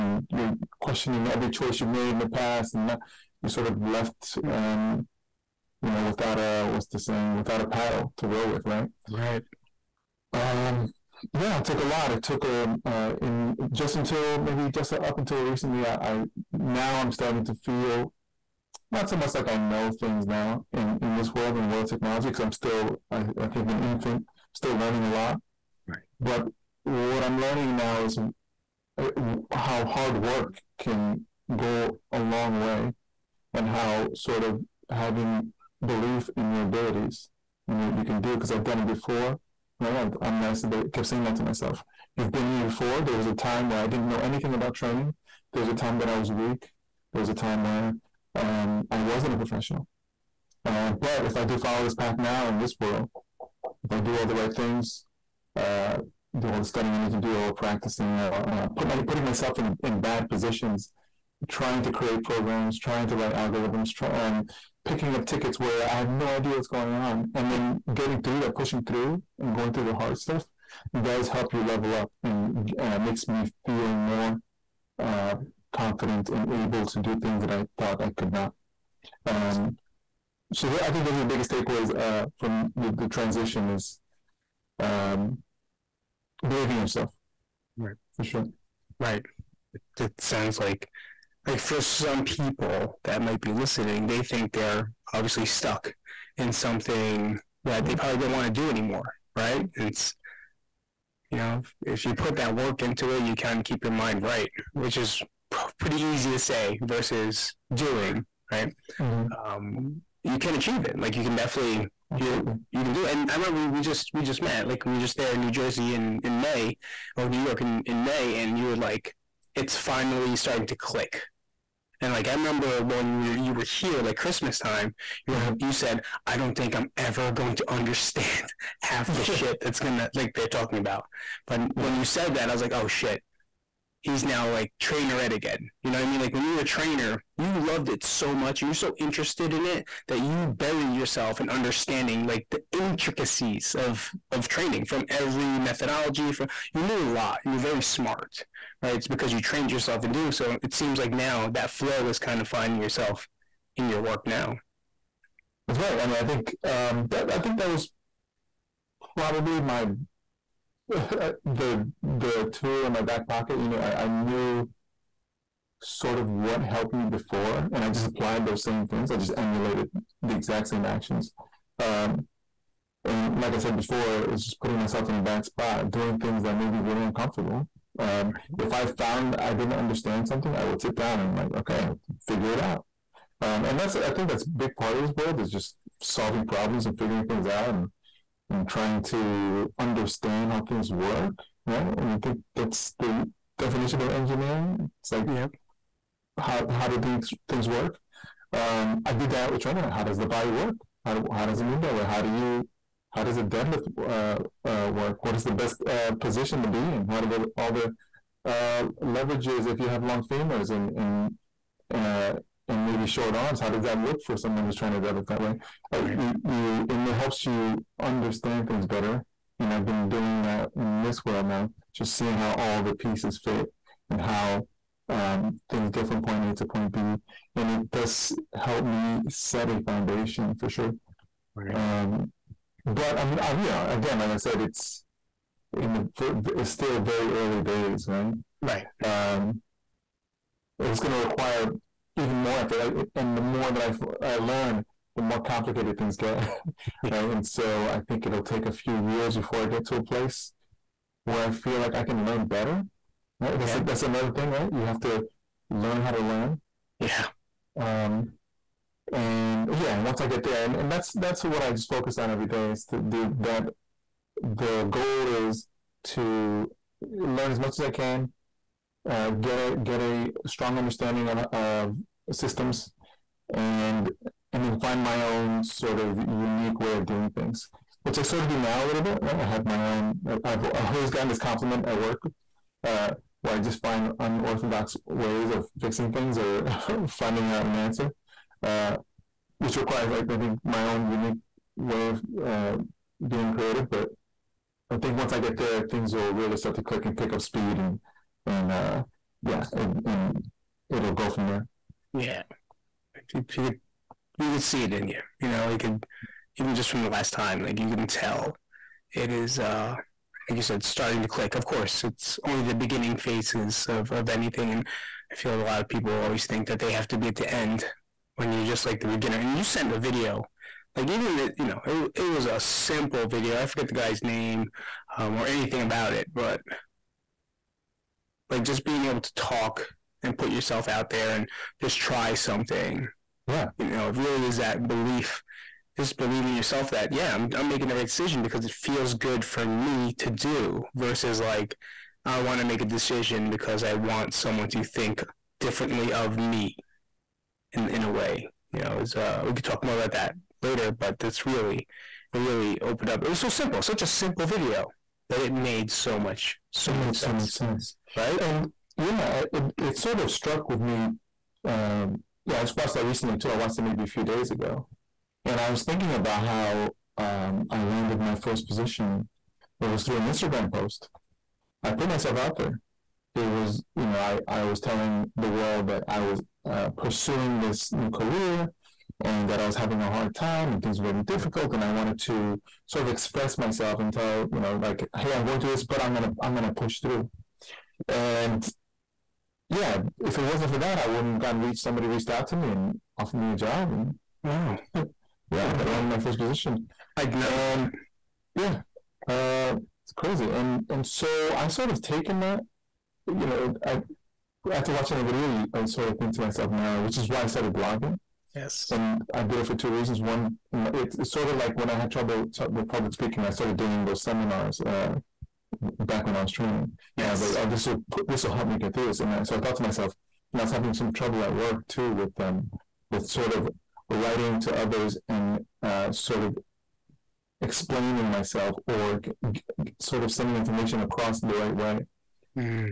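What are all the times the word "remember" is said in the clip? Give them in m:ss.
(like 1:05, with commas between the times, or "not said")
1:53, 2:02.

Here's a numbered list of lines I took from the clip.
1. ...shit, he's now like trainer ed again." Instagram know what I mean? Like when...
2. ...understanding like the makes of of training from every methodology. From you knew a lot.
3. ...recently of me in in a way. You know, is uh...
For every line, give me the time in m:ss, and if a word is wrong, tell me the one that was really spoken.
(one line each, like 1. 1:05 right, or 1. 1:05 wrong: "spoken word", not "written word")
1. 2:12 wrong: "You", not "Instagram"
2. 2:21 wrong: "intricacies", not "makes"
3. 5:45 wrong: "differently", not "recently".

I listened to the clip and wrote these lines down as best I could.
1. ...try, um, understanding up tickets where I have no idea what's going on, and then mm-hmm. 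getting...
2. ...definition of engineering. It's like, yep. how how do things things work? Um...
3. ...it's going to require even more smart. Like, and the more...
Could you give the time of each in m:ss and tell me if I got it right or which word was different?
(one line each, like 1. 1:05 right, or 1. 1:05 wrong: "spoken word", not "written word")
1. 1:03 wrong: "picking", not "understanding"
2. 3:13 right
3. 4:00 wrong: "effort", not "smart".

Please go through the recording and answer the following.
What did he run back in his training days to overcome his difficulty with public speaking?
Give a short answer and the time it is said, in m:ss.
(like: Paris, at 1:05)
seminars, at 6:54.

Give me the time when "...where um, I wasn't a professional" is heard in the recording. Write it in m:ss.
0:47.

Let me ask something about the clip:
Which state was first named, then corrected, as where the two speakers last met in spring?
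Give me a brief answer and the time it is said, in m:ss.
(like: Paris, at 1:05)
New Jersey, at 1:55.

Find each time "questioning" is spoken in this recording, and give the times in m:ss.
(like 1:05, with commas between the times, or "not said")
0:00.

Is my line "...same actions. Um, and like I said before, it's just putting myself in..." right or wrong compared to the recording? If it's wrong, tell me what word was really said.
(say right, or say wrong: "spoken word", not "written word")
right.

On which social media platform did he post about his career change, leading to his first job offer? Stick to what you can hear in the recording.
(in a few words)
Instagram.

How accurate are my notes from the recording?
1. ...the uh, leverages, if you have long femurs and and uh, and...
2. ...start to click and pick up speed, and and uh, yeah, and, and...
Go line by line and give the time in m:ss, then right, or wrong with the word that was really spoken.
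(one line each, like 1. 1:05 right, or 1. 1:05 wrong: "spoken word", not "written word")
1. 3:27 right
2. 4:56 right.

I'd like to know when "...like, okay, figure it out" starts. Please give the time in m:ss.
3:01.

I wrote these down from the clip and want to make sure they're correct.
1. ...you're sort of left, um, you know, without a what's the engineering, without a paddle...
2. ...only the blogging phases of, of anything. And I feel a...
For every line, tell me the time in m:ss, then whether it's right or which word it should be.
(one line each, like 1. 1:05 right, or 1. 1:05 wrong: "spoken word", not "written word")
1. 0:03 wrong: "saying", not "engineering"
2. 5:12 wrong: "beginning", not "blogging".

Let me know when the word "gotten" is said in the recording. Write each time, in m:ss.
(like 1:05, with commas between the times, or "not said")
4:41, 6:31.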